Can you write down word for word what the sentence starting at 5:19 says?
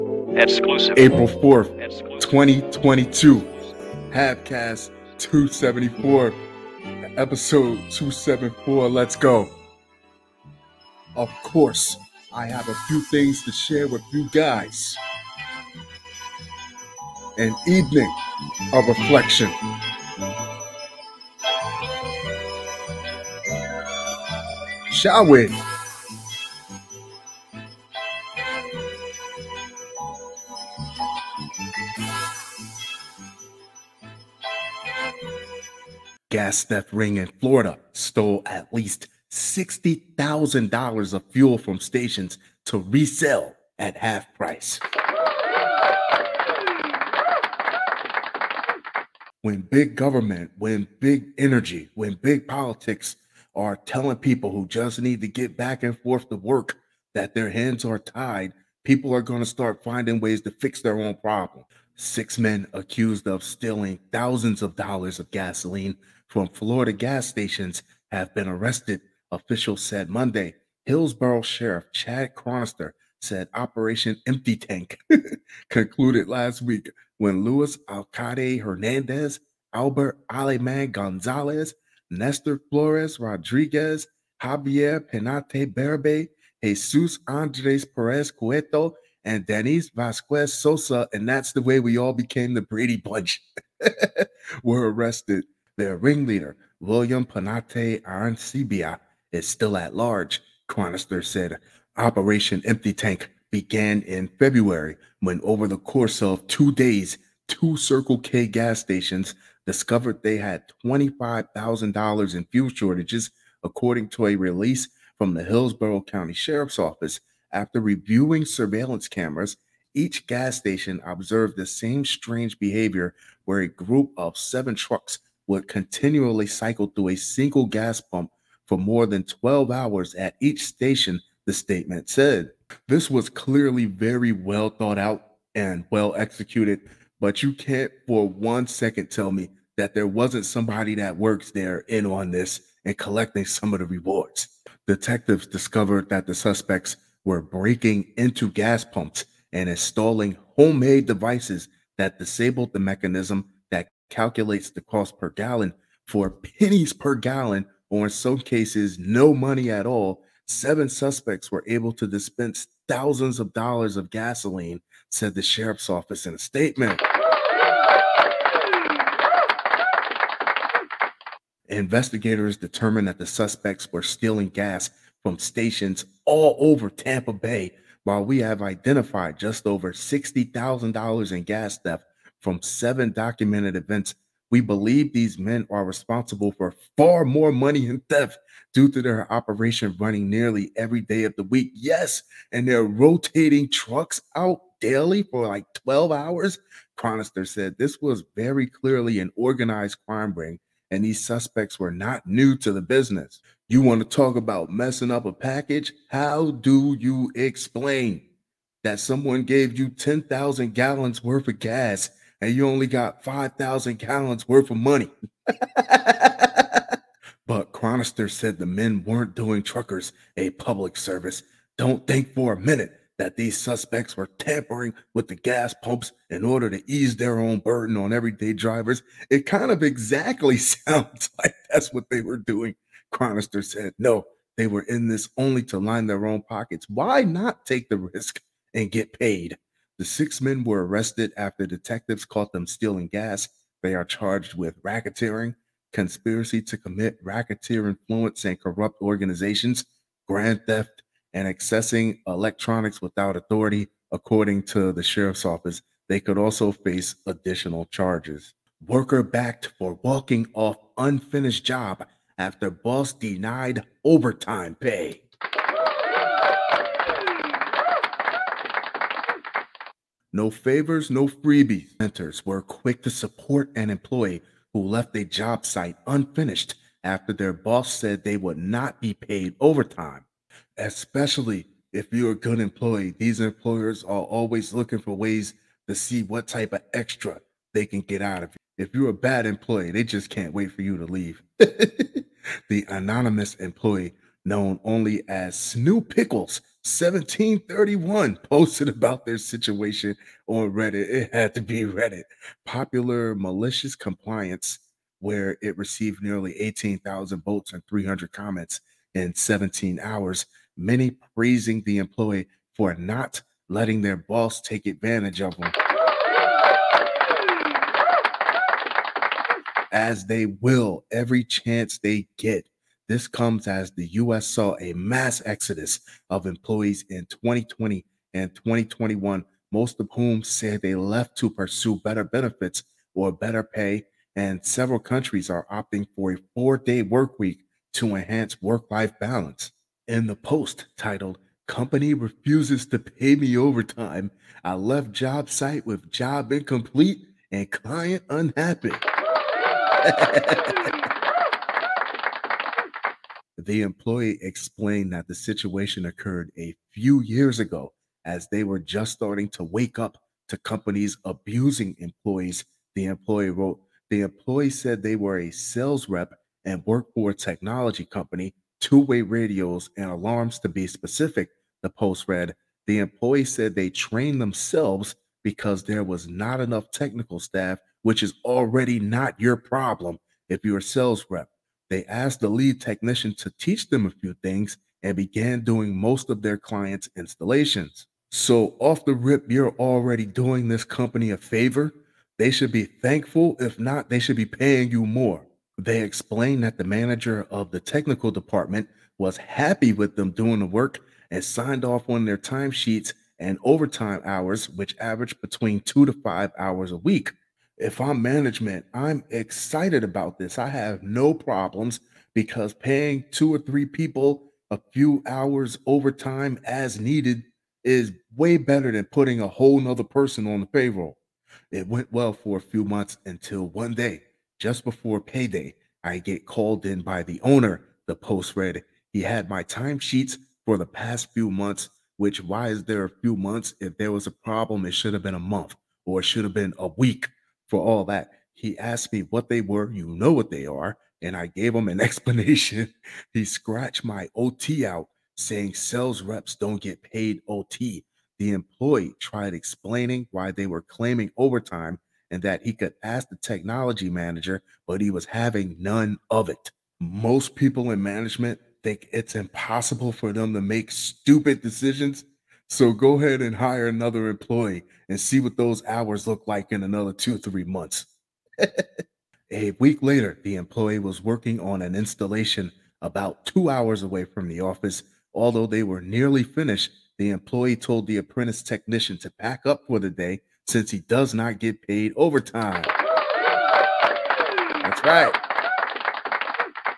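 As they will every chance they get.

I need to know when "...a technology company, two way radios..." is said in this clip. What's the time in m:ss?
6:07.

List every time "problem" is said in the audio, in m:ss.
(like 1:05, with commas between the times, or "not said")
1:01, 6:19, 6:51, 7:14.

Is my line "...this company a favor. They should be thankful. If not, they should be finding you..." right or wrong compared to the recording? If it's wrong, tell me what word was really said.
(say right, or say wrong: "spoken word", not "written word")
wrong: "paying", not "finding".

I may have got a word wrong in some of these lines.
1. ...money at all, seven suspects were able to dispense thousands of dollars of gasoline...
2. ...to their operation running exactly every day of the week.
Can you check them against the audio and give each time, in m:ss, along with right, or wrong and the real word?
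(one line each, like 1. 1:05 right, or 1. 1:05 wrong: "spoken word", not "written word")
1. 2:39 right
2. 3:08 wrong: "nearly", not "exactly".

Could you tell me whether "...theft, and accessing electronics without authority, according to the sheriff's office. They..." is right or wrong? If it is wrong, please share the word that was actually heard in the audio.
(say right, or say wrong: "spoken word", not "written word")
right.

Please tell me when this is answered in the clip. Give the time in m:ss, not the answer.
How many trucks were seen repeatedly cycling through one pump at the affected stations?
2:04.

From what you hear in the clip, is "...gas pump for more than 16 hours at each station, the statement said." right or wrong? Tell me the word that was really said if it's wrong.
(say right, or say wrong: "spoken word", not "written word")
wrong: "12", not "16".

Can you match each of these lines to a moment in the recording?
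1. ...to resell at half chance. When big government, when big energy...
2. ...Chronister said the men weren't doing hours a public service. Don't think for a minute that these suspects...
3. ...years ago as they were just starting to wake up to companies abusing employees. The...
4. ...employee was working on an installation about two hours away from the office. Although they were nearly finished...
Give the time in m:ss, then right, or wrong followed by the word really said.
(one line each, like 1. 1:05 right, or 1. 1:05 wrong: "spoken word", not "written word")
1. 0:42 wrong: "price", not "chance"
2. 3:37 wrong: "truckers", not "hours"
3. 5:57 right
4. 7:50 right.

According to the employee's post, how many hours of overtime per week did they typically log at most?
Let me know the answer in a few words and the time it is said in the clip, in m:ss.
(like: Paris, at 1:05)
5, at 6:45.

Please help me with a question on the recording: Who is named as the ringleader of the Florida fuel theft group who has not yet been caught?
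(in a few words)
William Panate Arancibia.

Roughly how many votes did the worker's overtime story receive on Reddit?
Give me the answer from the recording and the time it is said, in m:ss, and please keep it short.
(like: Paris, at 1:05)
18,000, at 5:06.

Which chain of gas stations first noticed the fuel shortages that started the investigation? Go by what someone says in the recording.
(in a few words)
Circle K.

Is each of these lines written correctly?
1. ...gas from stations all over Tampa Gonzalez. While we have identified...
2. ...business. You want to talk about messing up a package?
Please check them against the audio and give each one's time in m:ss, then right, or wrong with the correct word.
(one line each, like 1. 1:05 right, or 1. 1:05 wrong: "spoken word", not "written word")
1. 2:54 wrong: "Bay", not "Gonzalez"
2. 3:22 right.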